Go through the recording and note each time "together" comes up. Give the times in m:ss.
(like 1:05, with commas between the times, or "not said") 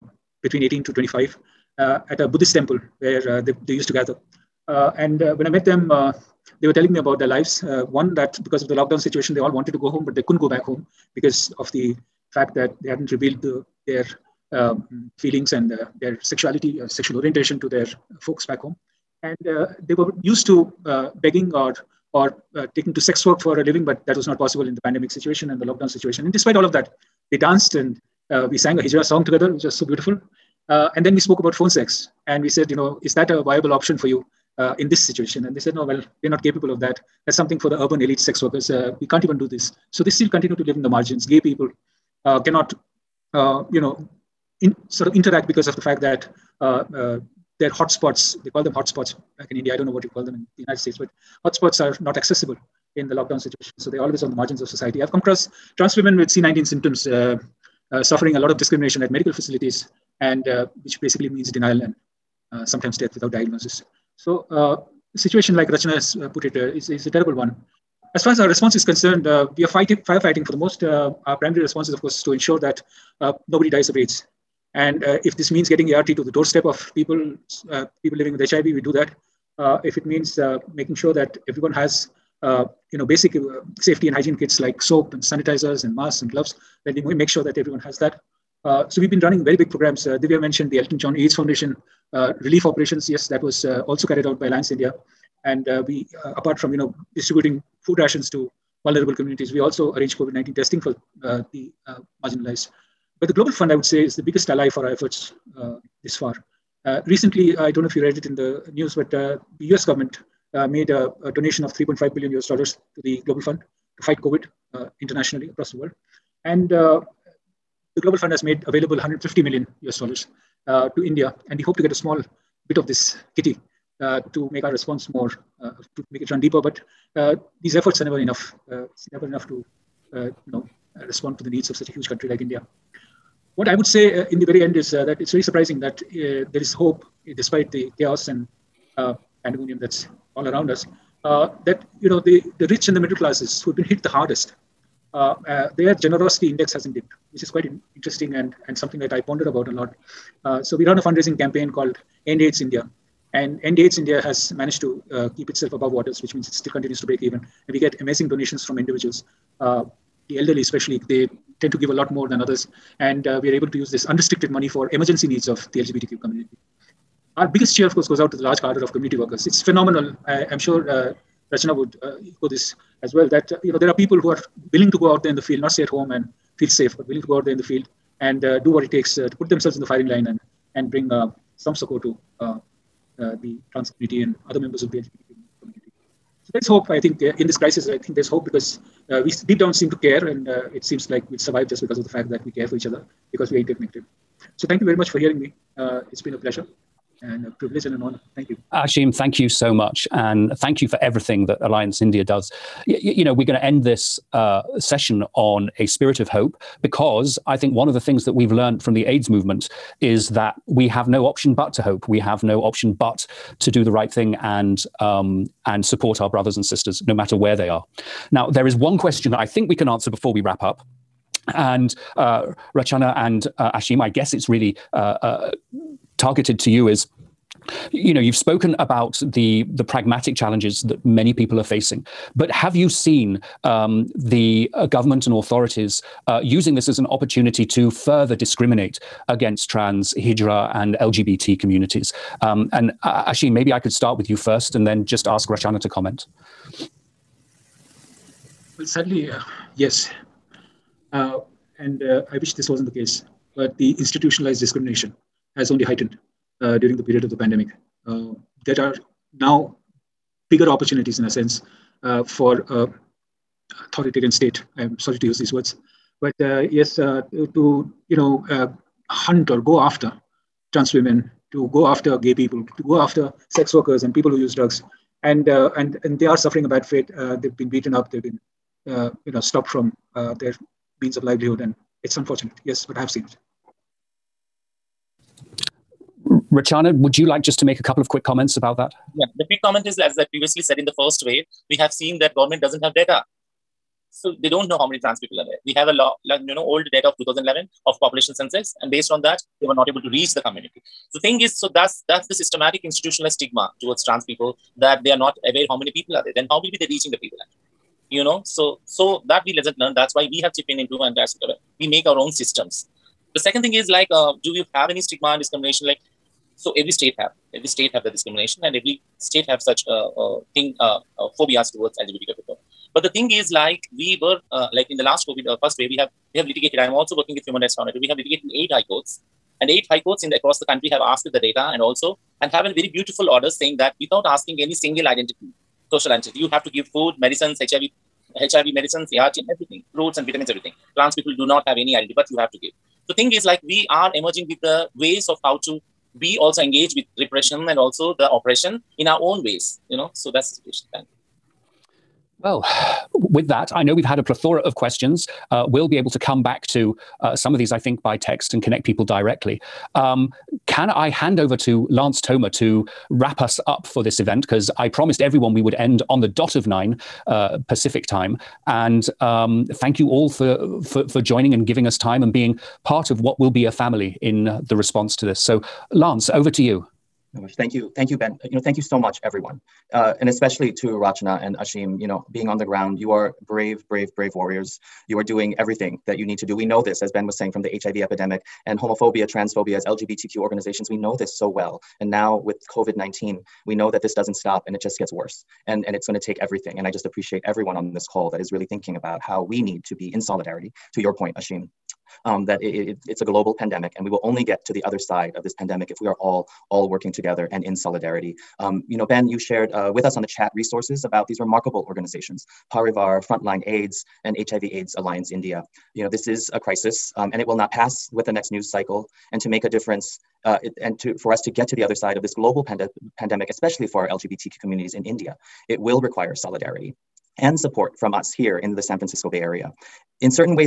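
0:29, 6:47.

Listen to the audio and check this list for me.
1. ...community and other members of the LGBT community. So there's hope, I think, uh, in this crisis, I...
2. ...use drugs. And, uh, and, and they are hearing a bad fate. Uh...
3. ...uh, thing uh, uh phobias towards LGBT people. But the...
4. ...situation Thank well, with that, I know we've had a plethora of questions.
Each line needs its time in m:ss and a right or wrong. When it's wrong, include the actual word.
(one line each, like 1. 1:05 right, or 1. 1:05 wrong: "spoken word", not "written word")
1. 3:03 right
2. 4:34 wrong: "suffering", not "hearing"
3. 5:20 right
4. 5:50 right.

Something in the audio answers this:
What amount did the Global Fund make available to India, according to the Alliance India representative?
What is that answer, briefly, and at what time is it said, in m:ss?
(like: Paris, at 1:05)
150 million US dollars, at 1:58.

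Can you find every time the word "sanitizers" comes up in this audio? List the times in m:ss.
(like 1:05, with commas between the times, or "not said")
1:25.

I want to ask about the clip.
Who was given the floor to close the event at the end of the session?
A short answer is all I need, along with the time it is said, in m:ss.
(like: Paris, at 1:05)
Lance Toma, at 6:01.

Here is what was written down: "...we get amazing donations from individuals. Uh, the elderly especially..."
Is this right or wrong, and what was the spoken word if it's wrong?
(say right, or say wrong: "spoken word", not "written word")
right.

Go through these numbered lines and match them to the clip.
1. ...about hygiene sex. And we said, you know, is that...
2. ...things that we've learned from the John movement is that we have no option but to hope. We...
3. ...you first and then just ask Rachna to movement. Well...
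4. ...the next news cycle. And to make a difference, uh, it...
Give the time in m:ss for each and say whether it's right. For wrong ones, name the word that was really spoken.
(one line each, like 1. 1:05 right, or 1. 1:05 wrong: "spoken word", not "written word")
1. 0:31 wrong: "phone", not "hygiene"
2. 3:27 wrong: "AIDS", not "John"
3. 4:04 wrong: "comment", not "movement"
4. 6:58 right.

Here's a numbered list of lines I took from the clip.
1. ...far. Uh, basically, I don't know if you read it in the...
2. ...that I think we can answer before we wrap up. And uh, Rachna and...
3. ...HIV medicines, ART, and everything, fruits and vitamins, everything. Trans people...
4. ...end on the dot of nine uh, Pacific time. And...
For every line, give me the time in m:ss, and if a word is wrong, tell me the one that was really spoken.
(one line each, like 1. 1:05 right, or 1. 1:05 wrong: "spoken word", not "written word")
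1. 1:46 wrong: "recently", not "basically"
2. 3:39 right
3. 5:38 right
4. 6:05 right.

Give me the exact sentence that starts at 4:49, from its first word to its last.
Yeah, the quick comment is as I previously said in the first wave, we have seen that government doesn't have data.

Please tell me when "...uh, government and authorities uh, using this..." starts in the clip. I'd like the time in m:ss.
3:54.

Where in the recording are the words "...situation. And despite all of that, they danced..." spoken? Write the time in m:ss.
0:25.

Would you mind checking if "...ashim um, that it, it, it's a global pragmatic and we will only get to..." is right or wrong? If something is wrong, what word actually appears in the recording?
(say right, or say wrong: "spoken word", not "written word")
wrong: "pandemic", not "pragmatic".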